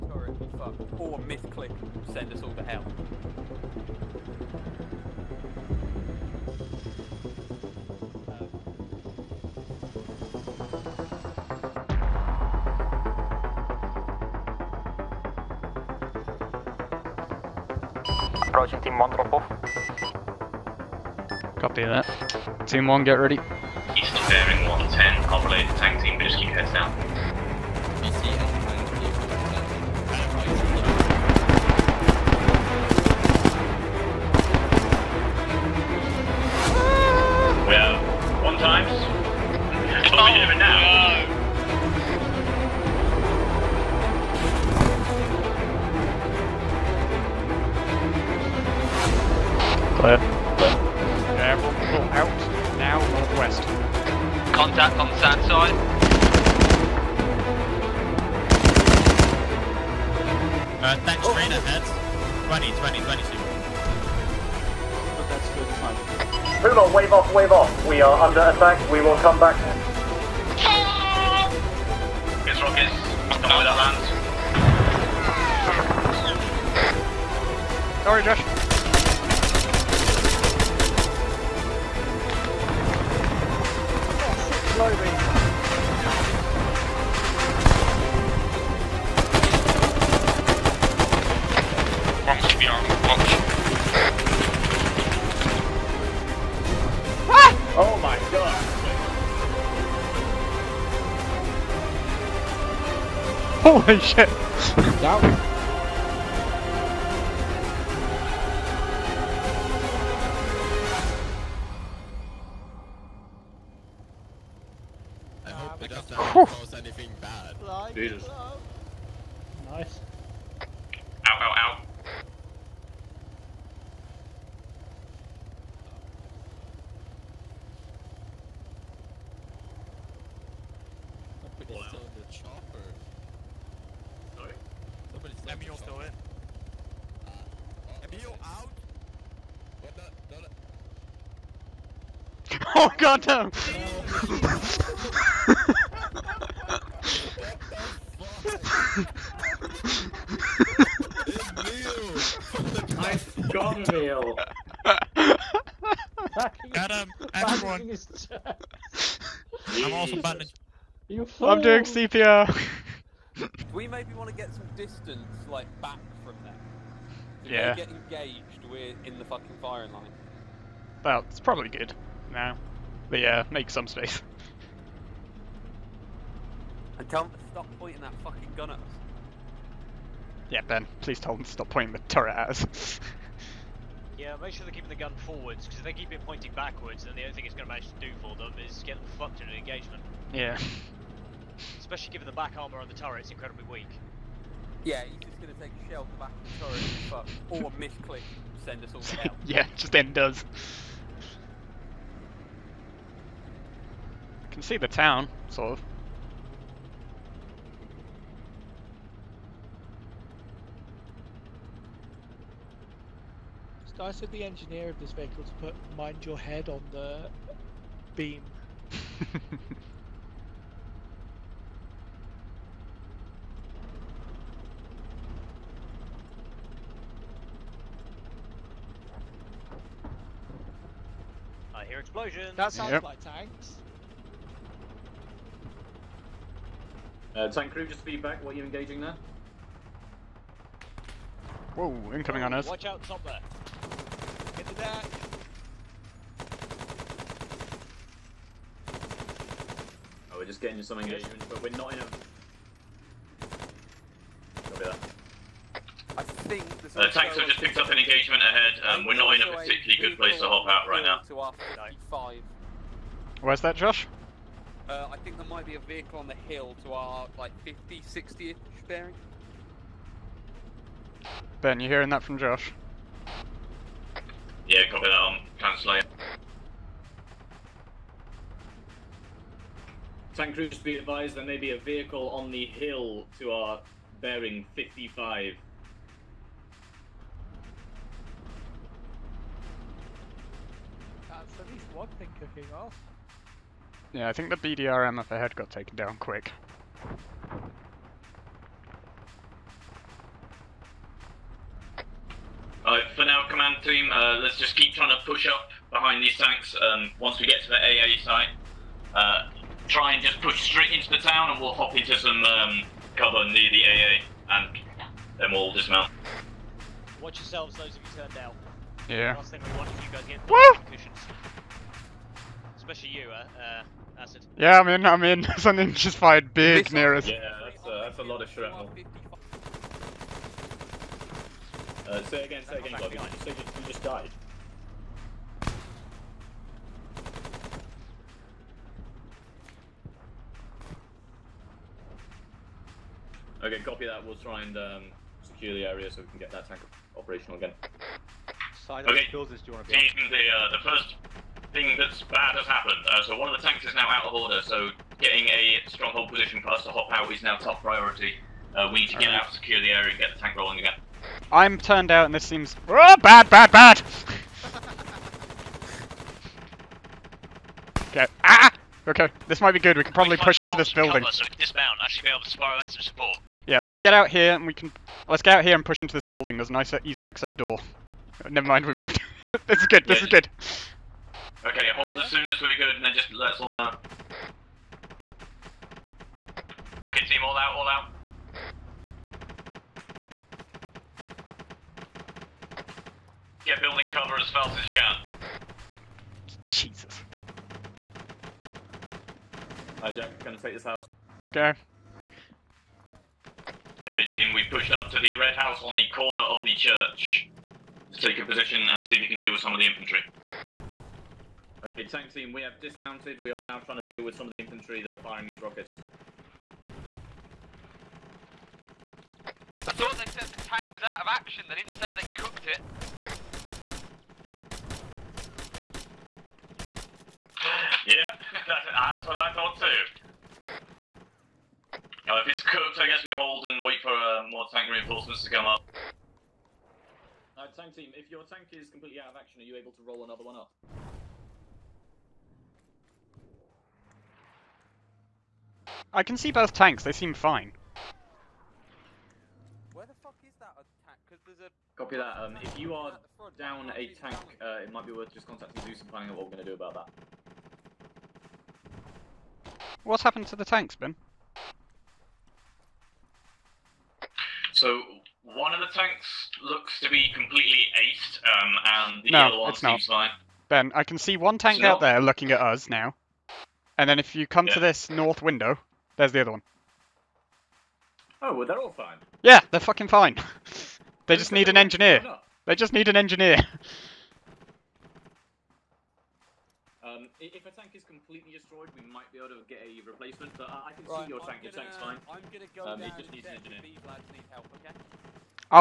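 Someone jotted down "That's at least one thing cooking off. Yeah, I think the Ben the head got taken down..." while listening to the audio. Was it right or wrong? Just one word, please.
wrong.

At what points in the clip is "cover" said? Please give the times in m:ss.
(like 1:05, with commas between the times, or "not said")
5:13, 6:11, 6:34.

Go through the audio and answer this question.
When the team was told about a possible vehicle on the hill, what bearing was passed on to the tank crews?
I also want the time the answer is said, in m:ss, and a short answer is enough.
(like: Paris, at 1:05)
55, at 4:44.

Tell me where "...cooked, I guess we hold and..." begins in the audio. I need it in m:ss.
7:12.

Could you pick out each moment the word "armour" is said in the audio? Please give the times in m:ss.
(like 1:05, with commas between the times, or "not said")
3:12.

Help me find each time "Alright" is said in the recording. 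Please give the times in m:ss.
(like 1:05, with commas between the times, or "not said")
5:02, 7:17.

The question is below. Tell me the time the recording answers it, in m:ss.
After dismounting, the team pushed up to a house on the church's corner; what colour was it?
6:45.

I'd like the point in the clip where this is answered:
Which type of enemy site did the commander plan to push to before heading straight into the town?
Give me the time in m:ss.
5:07.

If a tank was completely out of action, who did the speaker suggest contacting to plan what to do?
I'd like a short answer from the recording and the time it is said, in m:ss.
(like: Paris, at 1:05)
Zeus, at 7:35.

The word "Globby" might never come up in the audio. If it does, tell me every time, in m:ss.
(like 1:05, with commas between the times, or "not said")
5:32.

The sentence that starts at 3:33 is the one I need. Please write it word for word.
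I said the engineer of this vehicle to put mind your head on the beam.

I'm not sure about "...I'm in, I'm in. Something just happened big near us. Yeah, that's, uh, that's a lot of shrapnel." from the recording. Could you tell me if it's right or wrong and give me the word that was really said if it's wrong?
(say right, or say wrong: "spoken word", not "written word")
wrong: "fired", not "happened".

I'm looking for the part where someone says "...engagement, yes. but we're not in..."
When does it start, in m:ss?
4:10.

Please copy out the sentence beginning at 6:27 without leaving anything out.
Okay, team, all out, all out.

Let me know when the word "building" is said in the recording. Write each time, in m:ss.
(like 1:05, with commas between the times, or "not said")
6:10, 6:16, 6:33.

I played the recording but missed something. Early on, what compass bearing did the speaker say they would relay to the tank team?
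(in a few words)
110.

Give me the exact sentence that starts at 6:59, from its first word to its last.
I thought they said the tank was out of action.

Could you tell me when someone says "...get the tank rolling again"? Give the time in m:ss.
6:00.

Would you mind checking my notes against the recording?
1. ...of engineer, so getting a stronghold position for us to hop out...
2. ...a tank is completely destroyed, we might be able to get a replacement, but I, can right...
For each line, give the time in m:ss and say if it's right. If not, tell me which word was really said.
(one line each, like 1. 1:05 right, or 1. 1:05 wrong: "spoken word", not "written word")
1. 5:54 wrong: "order", not "engineer"
2. 8:07 right.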